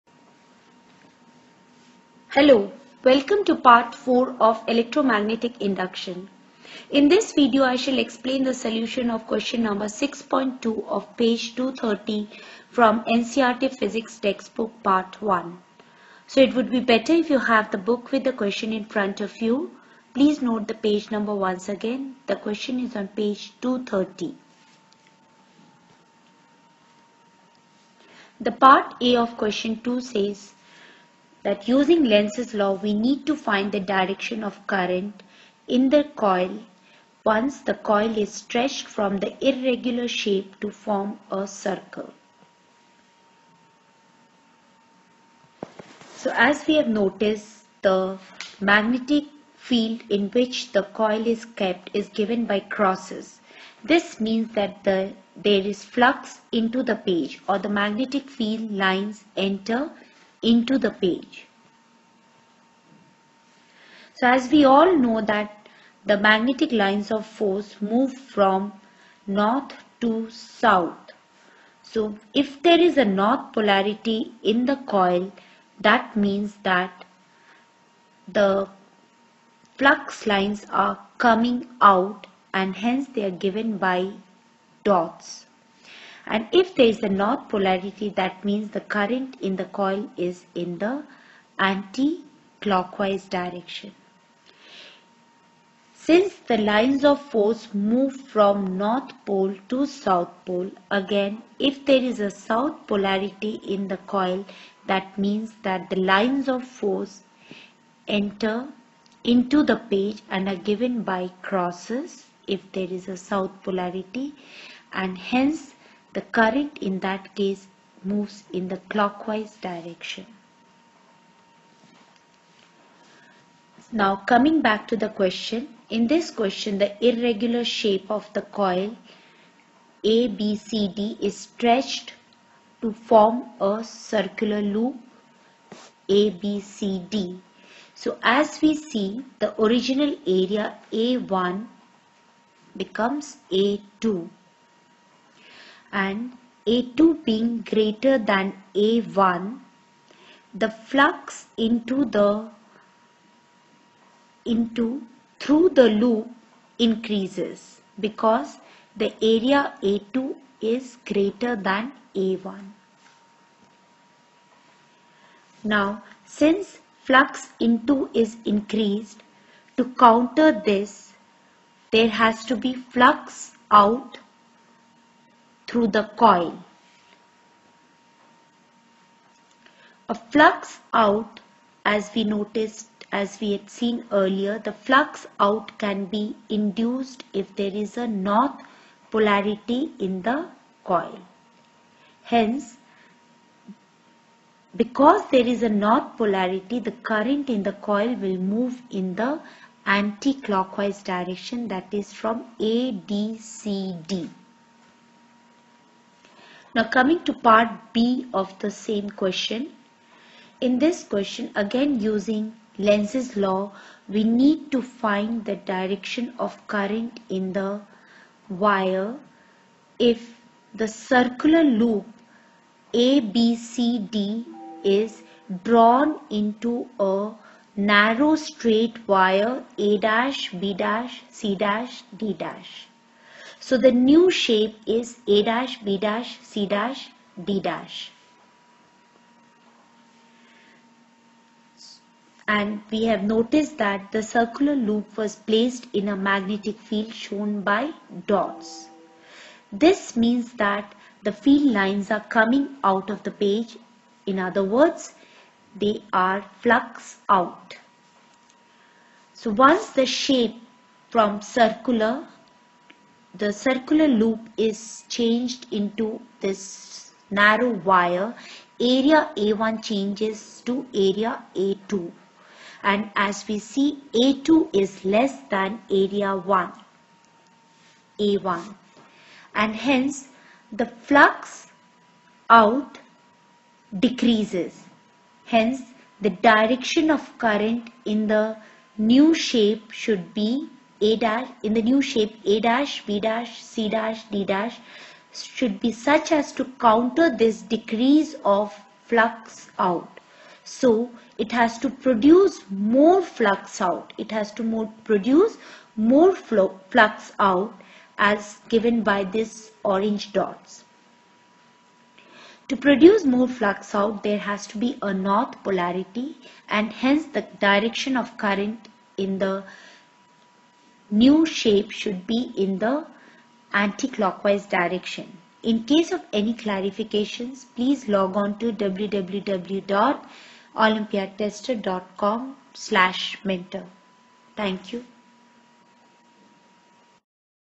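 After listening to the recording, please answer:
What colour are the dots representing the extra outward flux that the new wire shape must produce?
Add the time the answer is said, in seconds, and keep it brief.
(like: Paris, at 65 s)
Orange, at 309 s.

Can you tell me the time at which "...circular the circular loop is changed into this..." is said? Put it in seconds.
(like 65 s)
261 s.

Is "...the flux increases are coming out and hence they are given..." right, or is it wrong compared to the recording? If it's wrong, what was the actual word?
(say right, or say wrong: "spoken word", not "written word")
wrong: "lines", not "increases".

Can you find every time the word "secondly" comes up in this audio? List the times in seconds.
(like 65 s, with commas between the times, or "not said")
not said.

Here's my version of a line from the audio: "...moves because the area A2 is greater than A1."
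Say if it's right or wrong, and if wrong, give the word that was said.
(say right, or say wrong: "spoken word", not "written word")
wrong: "increases", not "moves".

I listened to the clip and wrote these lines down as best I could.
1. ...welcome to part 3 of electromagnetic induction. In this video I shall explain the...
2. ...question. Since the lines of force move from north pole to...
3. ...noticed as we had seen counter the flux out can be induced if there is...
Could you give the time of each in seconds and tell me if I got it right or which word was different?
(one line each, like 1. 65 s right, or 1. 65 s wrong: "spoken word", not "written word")
1. 3 s wrong: "4", not "3"
2. 93 s wrong: "direction", not "question"
3. 182 s wrong: "earlier", not "counter".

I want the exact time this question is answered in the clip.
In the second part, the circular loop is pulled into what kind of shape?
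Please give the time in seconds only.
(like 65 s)
227 s.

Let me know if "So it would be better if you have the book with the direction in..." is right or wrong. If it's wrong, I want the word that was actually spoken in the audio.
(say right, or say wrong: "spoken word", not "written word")
wrong: "question", not "direction".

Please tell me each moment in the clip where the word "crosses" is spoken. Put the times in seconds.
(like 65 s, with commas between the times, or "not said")
52 s, 111 s.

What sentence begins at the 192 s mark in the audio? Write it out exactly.
Hence because there is a north polarity the current in the coil will move in the anti-clockwise direction that is from ADCD.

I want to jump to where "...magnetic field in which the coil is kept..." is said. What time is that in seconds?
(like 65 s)
48 s.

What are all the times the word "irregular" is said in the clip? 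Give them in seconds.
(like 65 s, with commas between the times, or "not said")
39 s, 127 s.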